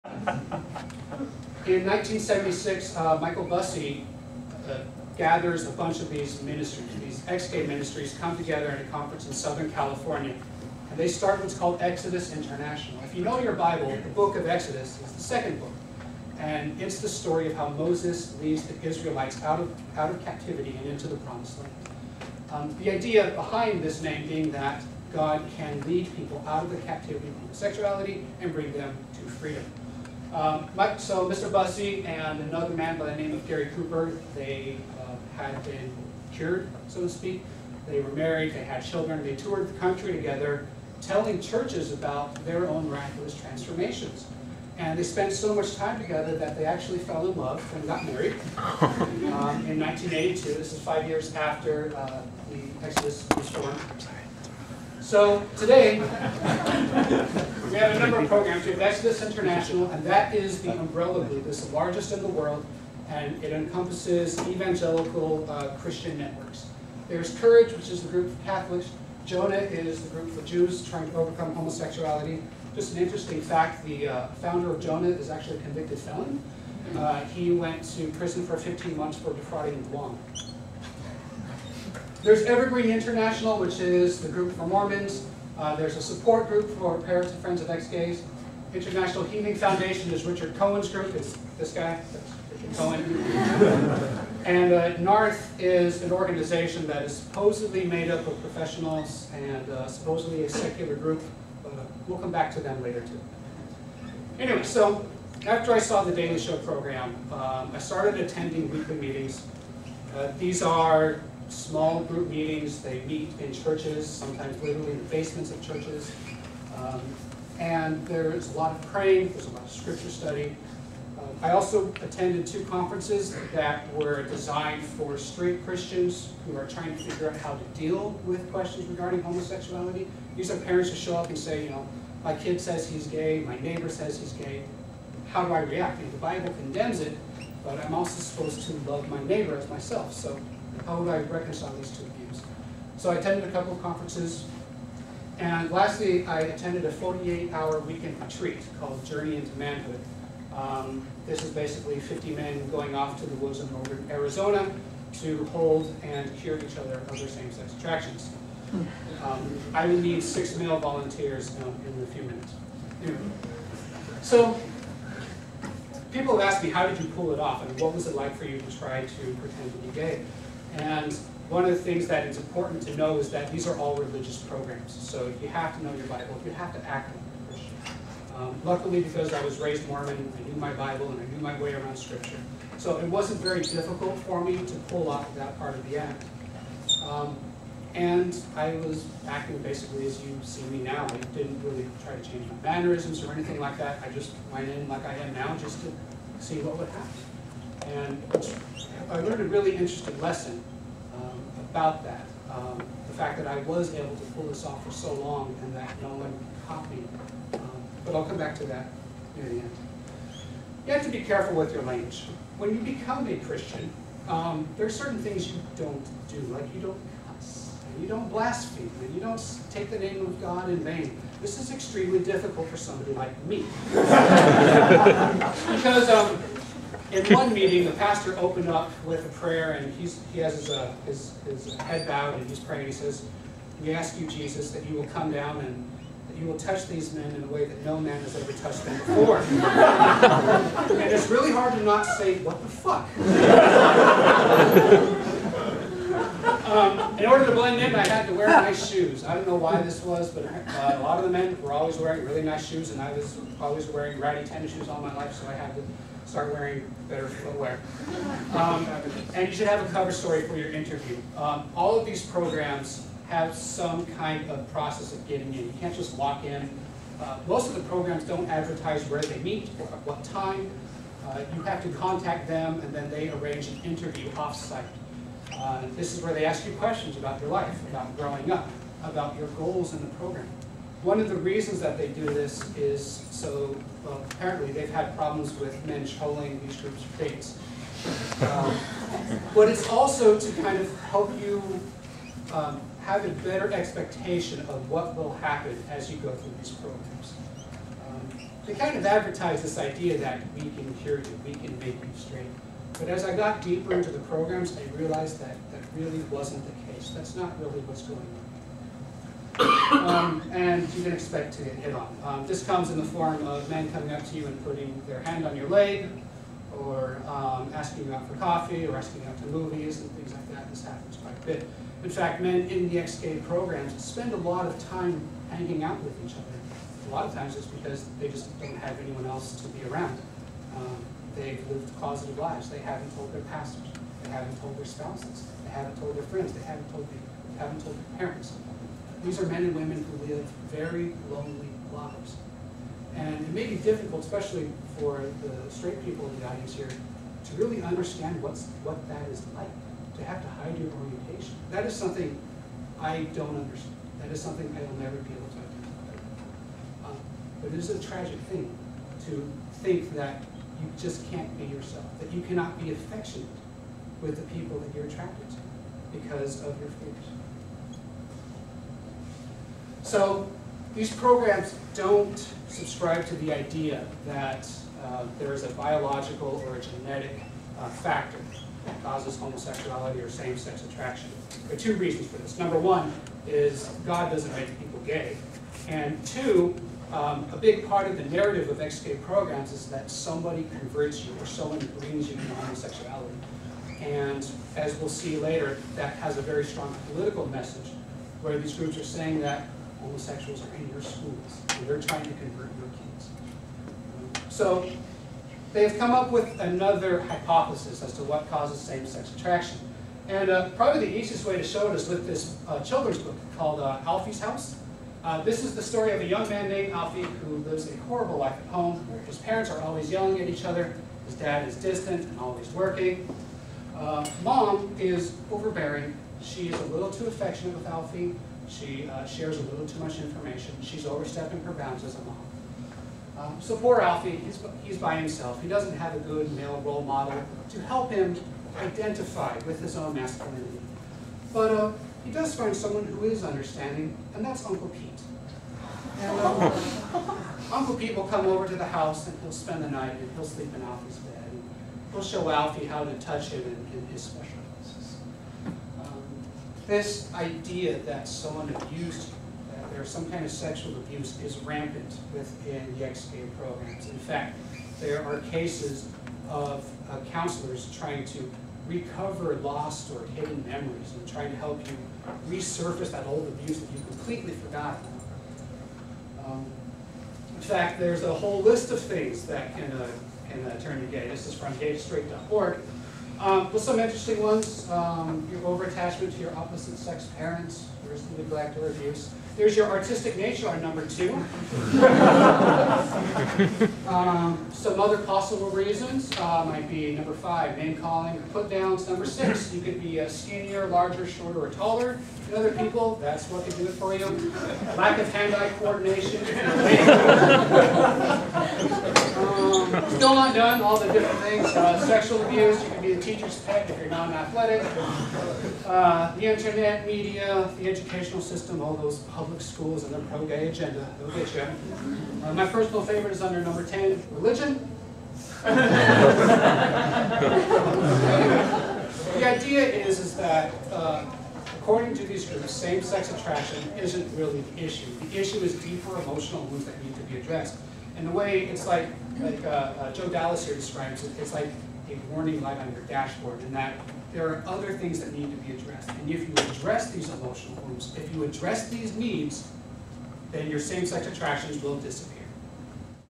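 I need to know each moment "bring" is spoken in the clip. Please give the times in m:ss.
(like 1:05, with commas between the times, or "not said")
0:28, 6:31.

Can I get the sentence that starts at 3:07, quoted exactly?
Um, and I was acting basically as you see me now.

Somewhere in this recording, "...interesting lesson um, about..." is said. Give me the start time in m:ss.
3:19.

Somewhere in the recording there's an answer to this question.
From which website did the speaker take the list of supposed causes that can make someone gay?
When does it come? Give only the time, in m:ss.
8:01.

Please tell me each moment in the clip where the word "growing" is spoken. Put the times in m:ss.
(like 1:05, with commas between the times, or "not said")
4:38.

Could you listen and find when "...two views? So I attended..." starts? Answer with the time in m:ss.
2:21.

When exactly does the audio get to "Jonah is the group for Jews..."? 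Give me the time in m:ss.
1:09.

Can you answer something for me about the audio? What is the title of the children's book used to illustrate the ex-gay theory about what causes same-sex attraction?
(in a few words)
Alfie's House.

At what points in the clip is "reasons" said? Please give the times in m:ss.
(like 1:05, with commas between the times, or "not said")
4:41, 6:21, 8:15.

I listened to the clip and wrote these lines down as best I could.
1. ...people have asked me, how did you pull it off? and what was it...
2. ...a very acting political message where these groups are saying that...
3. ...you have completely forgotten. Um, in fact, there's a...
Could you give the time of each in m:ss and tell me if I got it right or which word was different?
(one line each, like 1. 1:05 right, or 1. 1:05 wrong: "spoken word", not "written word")
1. 2:46 right
2. 6:36 wrong: "strong", not "acting"
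3. 7:53 right.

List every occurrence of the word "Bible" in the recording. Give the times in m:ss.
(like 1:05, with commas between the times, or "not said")
0:13, 2:16, 2:56, 3:00.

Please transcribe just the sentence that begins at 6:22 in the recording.
Number one is God doesn't make people gay.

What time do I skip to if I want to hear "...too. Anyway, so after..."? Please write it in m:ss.
1:43.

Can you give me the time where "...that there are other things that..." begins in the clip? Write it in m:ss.
9:03.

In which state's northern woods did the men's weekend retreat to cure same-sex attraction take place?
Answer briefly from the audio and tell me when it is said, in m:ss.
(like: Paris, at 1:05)
Arizona, at 2:34.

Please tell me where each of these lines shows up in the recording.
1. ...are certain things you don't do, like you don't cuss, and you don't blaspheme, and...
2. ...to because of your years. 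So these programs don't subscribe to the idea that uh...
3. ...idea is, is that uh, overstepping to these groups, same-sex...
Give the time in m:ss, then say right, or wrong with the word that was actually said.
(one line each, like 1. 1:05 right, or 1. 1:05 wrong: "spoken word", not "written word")
1. 3:34 right
2. 6:05 wrong: "fears", not "years"
3. 8:49 wrong: "according", not "overstepping".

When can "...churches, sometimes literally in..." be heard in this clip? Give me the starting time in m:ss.
1:53.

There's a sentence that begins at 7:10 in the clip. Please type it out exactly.
She's overstepping her bounds as a mom.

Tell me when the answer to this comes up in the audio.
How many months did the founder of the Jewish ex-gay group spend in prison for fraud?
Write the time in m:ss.
1:18.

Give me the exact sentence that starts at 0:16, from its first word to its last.
And it's the story of how Moses leads the Israelites out of, out of captivity and into the promised land.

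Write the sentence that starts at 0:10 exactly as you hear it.
And they start what's called Exodus International.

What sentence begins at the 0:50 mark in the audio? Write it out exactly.
This is five years after uh, the Exodus was formed.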